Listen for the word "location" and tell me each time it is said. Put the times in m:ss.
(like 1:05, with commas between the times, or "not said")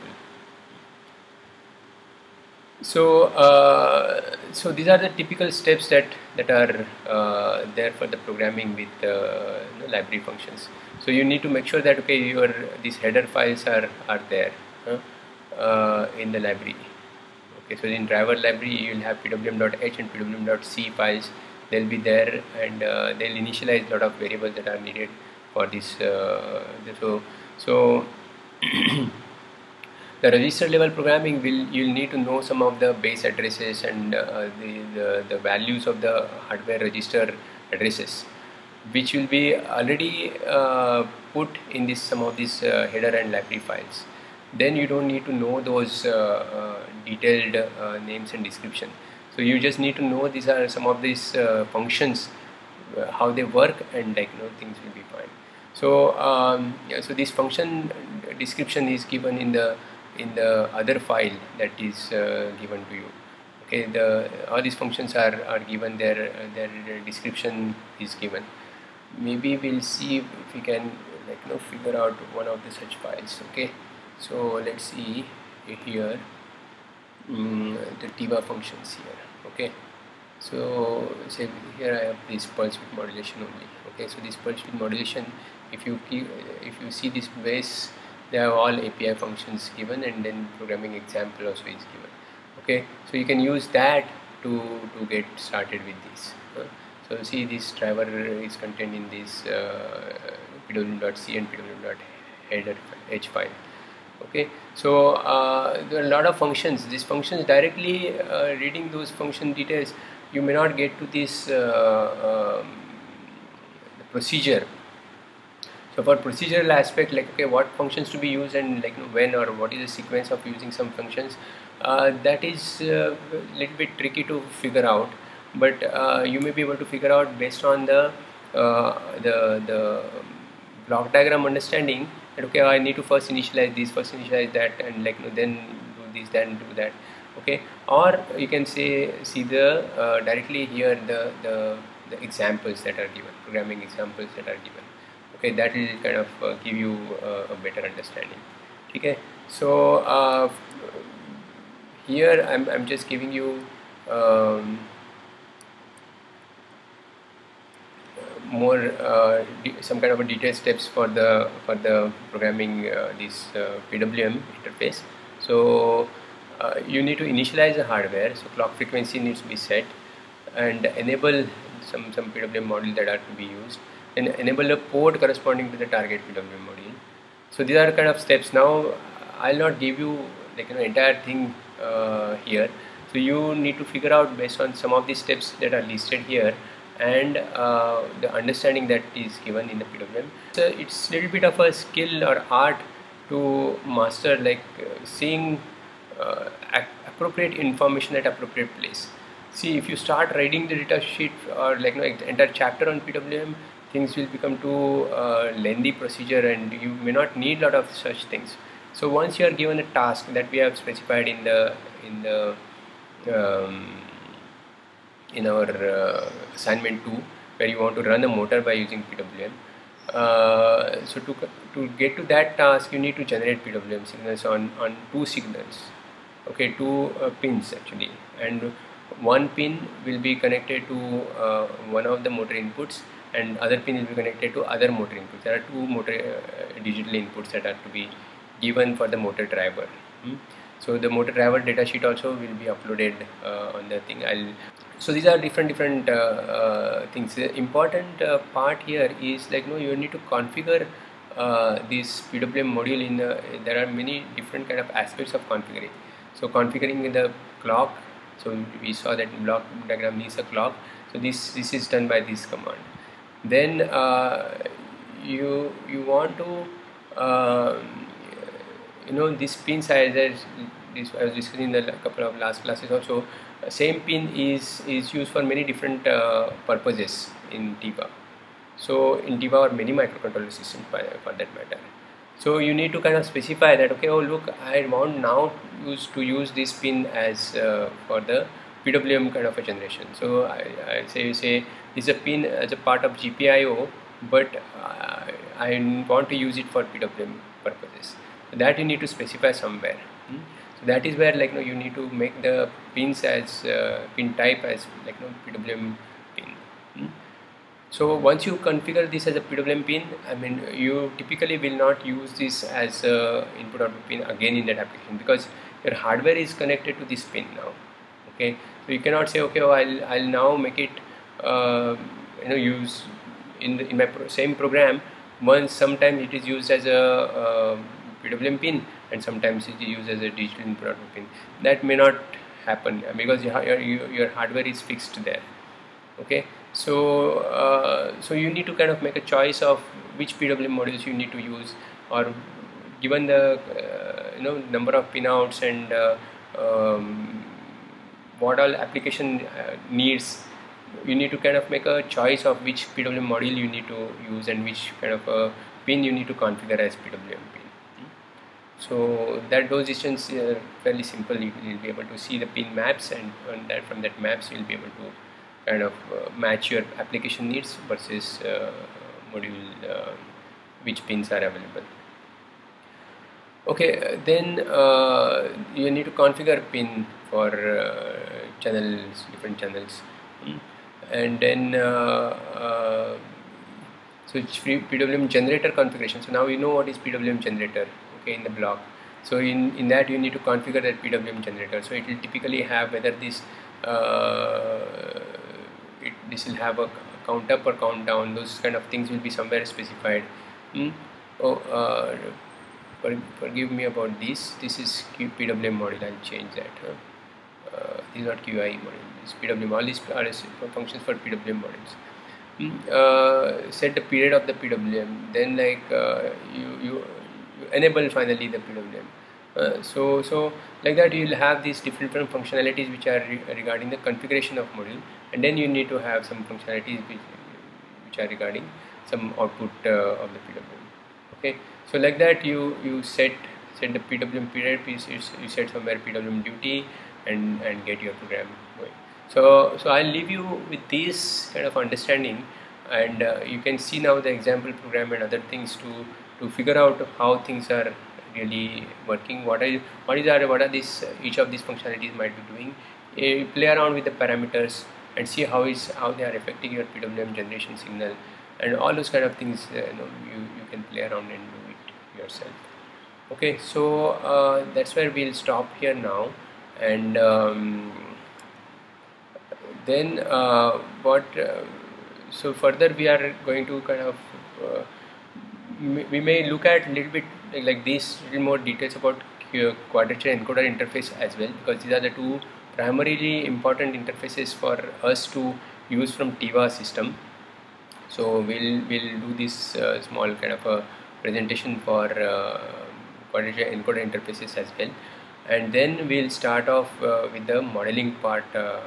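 not said.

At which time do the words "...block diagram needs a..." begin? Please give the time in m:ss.
4:19.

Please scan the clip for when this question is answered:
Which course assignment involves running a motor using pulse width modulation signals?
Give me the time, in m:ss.
3:36.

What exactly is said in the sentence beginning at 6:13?
Okay, then uh, you need to configure pin for uh, channels, different channels.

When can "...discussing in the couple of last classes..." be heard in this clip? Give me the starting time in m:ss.
4:31.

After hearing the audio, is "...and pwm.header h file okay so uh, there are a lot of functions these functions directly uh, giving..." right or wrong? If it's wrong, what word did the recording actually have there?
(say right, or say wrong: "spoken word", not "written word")
wrong: "reading", not "giving".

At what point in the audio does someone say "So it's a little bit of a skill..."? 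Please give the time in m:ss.
3:10.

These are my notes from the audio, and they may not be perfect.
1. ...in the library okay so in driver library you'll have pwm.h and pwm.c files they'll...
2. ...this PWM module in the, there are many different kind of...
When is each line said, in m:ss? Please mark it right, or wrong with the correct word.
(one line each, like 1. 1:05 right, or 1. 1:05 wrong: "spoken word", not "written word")
1. 0:16 right
2. 4:11 right.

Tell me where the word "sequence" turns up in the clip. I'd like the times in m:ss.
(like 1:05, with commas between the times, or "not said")
1:59.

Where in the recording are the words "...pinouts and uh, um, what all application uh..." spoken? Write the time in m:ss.
5:45.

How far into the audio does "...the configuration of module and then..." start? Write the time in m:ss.
7:03.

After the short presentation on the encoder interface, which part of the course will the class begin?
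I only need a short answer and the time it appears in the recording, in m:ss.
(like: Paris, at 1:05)
Modeling, at 8:17.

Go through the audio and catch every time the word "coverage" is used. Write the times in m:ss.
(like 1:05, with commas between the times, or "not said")
not said.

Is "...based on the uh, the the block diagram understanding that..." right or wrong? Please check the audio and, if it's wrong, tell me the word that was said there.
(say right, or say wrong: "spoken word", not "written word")
right.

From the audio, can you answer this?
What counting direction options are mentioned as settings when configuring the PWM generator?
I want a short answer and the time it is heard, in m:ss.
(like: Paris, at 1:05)
Count up or count down, at 6:37.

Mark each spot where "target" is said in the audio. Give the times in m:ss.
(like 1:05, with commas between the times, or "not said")
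2:55.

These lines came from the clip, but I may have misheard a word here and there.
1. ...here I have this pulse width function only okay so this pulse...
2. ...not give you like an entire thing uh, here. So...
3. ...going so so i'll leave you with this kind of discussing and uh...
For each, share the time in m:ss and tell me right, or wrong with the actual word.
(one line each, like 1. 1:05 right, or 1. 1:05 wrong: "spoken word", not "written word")
1. 1:21 wrong: "modulation", not "function"
2. 2:59 right
3. 7:18 wrong: "understanding", not "discussing".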